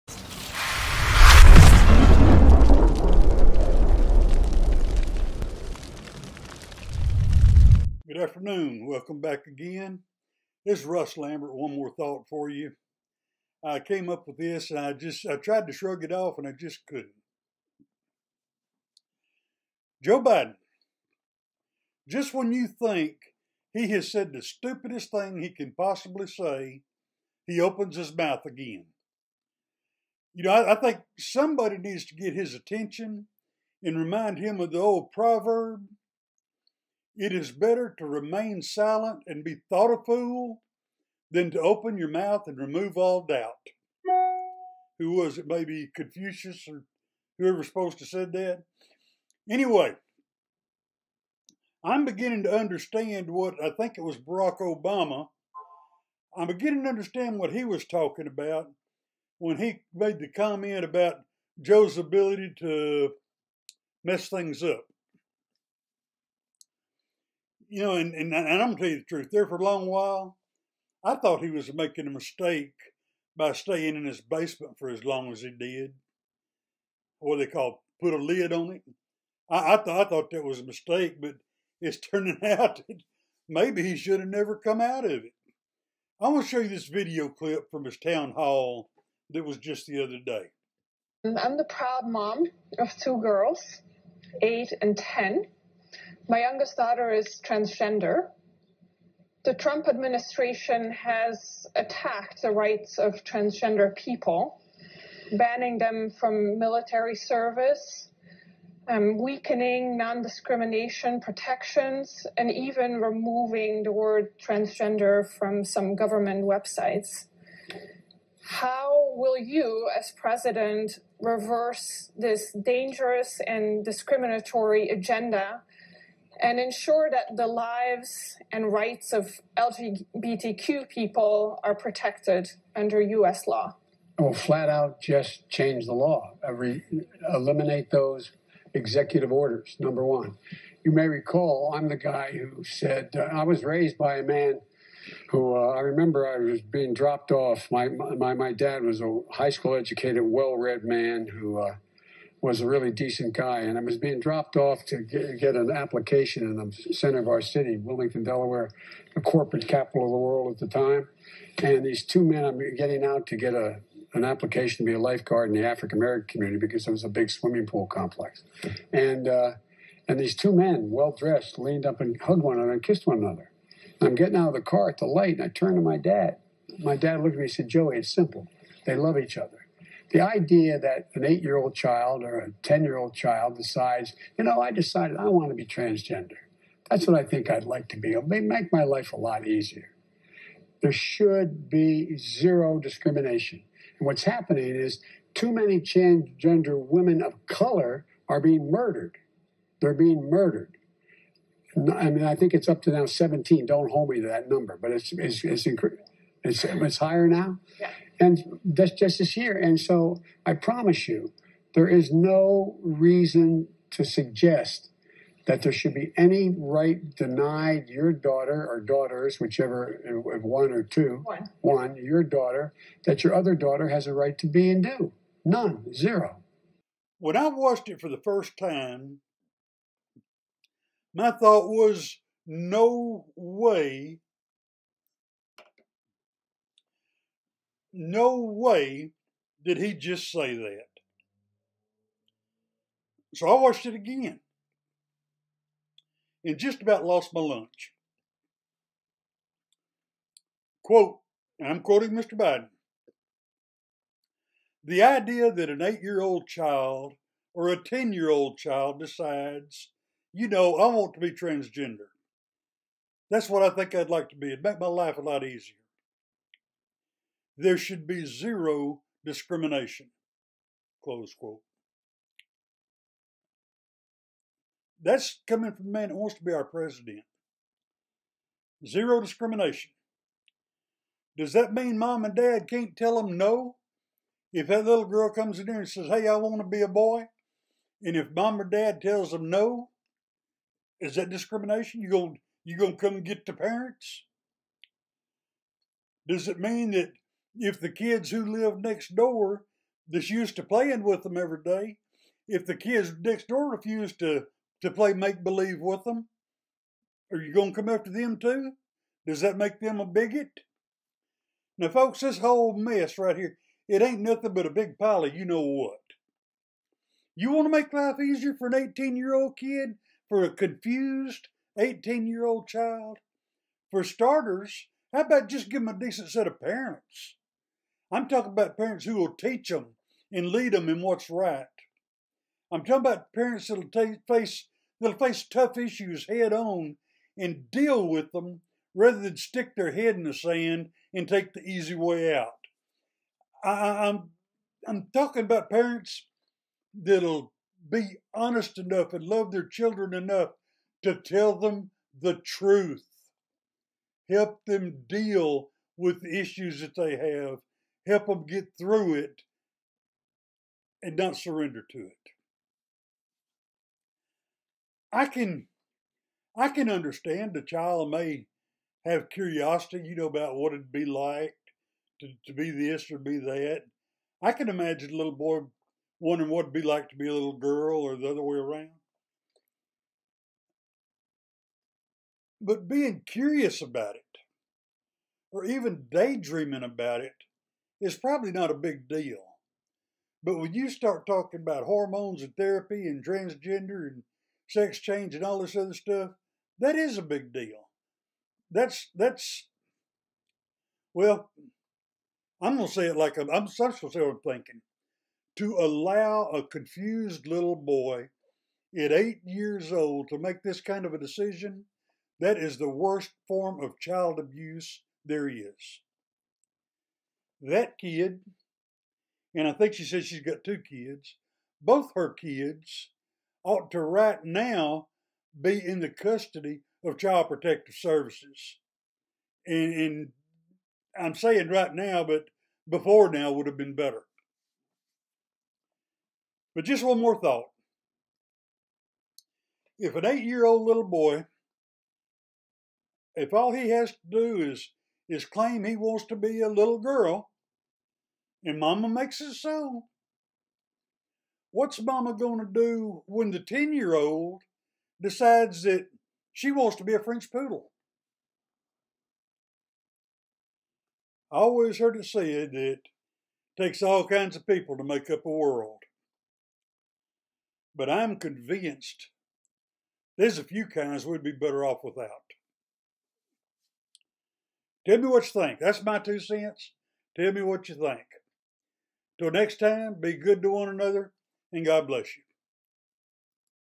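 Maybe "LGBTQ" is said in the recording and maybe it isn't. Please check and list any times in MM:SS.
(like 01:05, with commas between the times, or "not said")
02:09.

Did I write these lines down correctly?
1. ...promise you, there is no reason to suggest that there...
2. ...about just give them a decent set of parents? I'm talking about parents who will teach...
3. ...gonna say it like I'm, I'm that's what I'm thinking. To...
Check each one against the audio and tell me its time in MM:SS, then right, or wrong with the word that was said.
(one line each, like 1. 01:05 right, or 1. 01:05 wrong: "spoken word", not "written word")
1. 03:30 right
2. 05:25 right
3. 06:42 right.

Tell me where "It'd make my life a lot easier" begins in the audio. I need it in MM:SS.
04:24.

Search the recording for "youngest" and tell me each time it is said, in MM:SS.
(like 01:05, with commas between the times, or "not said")
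01:36.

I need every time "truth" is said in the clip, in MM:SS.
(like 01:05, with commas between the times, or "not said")
01:09, 05:52.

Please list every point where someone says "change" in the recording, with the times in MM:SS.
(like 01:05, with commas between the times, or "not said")
02:15, 06:34.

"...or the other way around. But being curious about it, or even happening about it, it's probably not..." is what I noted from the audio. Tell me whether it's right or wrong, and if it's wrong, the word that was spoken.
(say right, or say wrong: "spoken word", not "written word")
wrong: "daydreaming", not "happening".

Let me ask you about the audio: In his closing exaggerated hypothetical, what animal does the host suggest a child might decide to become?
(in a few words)
French poodle.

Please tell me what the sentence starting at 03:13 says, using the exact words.
And what's happening is too many transgender women of color are being murdered.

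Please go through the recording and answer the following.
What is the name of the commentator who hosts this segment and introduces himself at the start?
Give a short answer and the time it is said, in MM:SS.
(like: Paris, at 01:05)
Russ Lambert, at 00:10.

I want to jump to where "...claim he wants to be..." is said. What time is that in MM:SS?
07:25.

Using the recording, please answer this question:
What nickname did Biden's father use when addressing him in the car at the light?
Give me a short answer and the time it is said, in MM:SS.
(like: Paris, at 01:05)
Joey, at 02:57.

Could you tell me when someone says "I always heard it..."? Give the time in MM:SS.
07:41.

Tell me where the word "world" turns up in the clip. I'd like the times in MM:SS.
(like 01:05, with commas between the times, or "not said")
02:40, 07:45.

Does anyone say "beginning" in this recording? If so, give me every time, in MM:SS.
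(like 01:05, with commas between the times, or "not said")
00:52, 00:56.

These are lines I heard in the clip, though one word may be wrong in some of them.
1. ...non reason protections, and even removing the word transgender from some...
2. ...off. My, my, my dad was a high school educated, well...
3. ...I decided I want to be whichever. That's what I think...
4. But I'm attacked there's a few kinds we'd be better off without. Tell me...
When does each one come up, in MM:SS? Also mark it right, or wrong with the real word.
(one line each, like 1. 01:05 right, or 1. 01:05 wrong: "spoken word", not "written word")
1. 01:49 wrong: "discrimination", not "reason"
2. 02:27 right
3. 03:04 wrong: "transgender", not "whichever"
4. 07:47 wrong: "convinced", not "attacked".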